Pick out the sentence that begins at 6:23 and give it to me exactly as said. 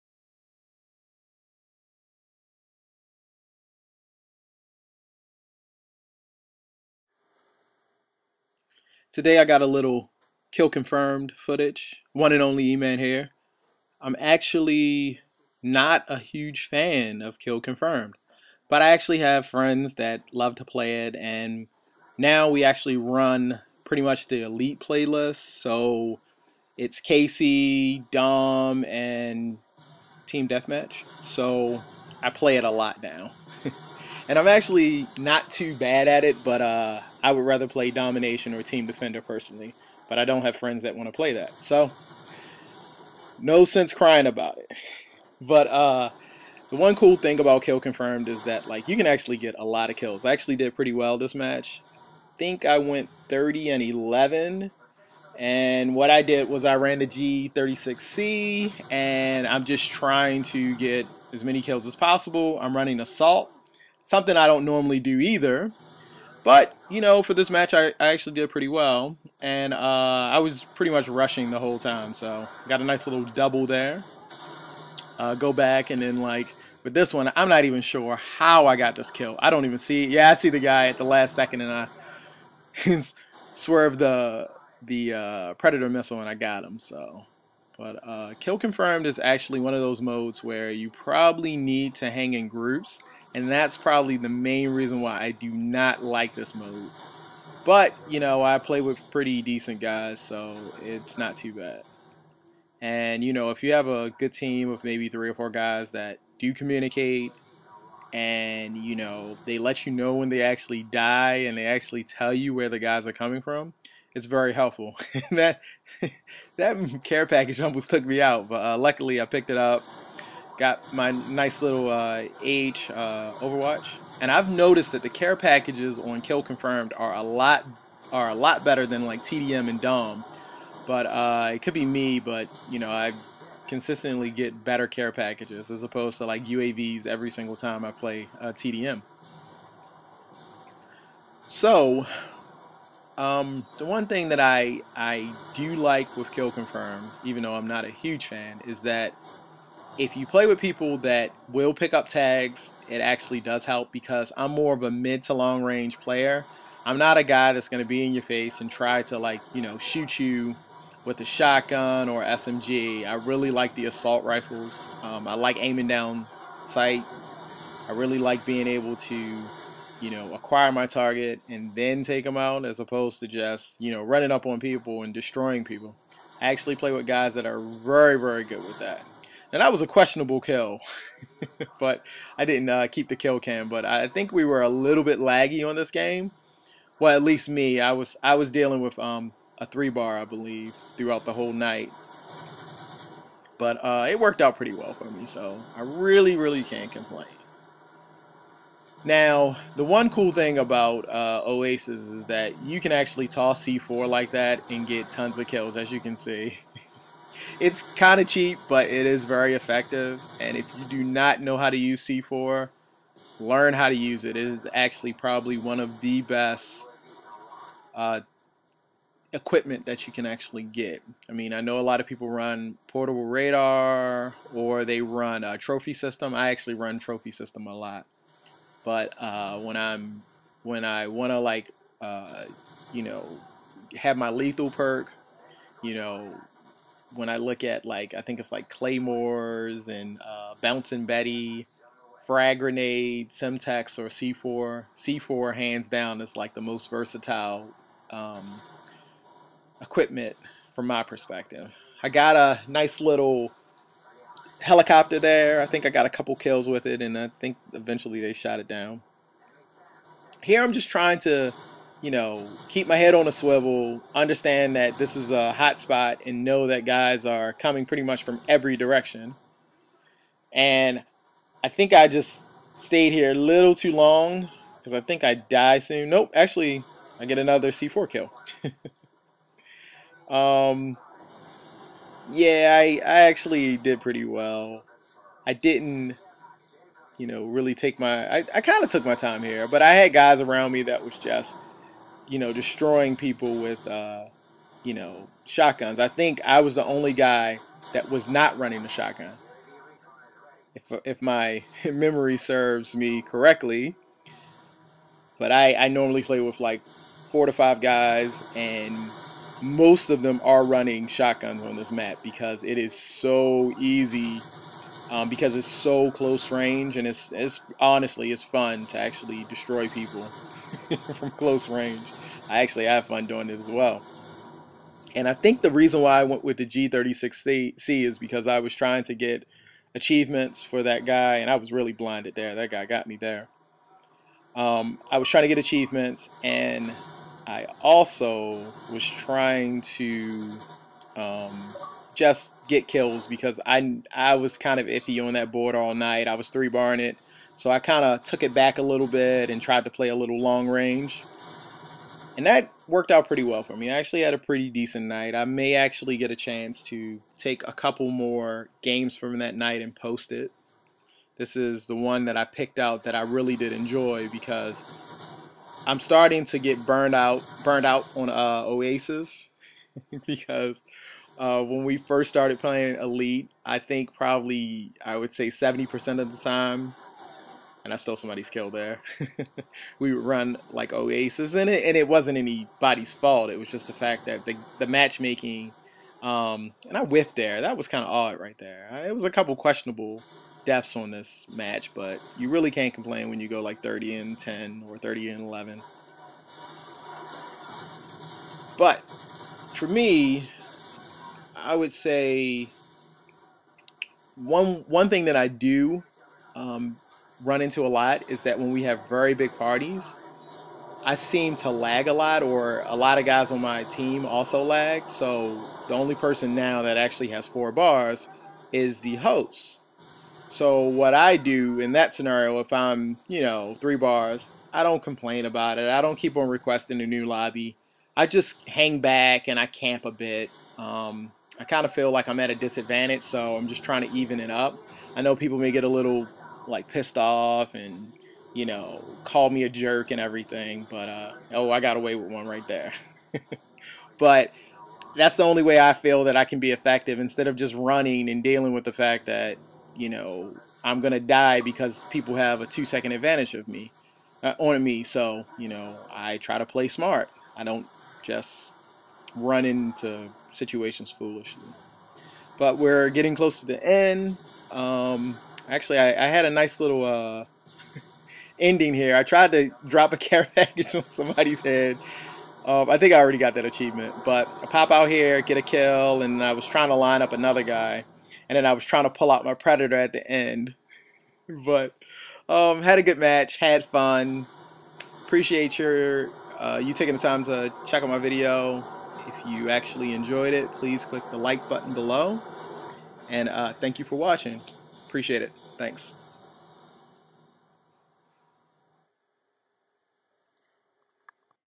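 It was just the fact that the, the matchmaking, um, and I whiffed there.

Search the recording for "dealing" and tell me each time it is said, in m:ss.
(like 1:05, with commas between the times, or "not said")
3:08, 7:28.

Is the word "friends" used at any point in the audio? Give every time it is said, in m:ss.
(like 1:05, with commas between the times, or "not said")
0:19, 0:40.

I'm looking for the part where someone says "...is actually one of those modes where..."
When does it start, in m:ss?
1:29.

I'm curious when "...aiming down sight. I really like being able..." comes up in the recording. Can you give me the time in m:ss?
2:45.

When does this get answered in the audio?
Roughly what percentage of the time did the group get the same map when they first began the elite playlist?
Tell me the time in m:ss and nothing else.
6:15.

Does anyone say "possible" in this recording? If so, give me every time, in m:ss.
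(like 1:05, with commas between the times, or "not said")
1:01.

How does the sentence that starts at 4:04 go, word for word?
C4 hands down is like the most versatile um, equipment from my perspective.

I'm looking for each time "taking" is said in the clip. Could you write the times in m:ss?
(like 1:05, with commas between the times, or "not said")
8:06.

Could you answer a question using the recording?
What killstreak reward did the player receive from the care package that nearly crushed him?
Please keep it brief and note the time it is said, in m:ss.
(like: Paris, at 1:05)
Overwatch, at 2:03.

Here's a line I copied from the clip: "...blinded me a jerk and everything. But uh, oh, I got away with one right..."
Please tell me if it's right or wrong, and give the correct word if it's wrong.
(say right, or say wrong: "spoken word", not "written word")
wrong: "called", not "blinded".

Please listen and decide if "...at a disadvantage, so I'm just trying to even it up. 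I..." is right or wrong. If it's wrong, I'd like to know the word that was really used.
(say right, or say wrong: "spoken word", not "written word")
right.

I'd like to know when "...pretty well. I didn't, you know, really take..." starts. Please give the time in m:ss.
4:44.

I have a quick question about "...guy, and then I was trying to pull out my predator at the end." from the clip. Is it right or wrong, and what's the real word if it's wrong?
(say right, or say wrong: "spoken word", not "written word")
right.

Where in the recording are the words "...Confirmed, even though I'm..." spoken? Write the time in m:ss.
2:26.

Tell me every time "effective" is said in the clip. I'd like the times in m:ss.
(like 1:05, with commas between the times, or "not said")
3:29, 7:26.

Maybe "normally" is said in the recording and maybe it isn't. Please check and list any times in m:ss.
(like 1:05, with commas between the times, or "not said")
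1:04, 5:05.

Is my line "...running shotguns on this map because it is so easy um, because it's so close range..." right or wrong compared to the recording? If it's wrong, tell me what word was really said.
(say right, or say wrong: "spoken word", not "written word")
right.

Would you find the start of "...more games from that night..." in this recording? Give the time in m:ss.
5:58.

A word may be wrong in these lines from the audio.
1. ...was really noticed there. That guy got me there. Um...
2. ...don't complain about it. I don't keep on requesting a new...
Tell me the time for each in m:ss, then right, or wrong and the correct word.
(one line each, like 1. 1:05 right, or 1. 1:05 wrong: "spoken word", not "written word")
1. 5:31 wrong: "blinded", not "noticed"
2. 7:04 right.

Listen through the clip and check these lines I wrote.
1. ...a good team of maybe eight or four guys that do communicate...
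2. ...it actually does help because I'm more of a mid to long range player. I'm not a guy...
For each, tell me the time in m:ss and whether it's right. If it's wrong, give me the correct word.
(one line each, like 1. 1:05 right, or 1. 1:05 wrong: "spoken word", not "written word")
1. 1:43 wrong: "three", not "eight"
2. 2:32 right.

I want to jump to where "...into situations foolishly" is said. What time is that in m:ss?
7:39.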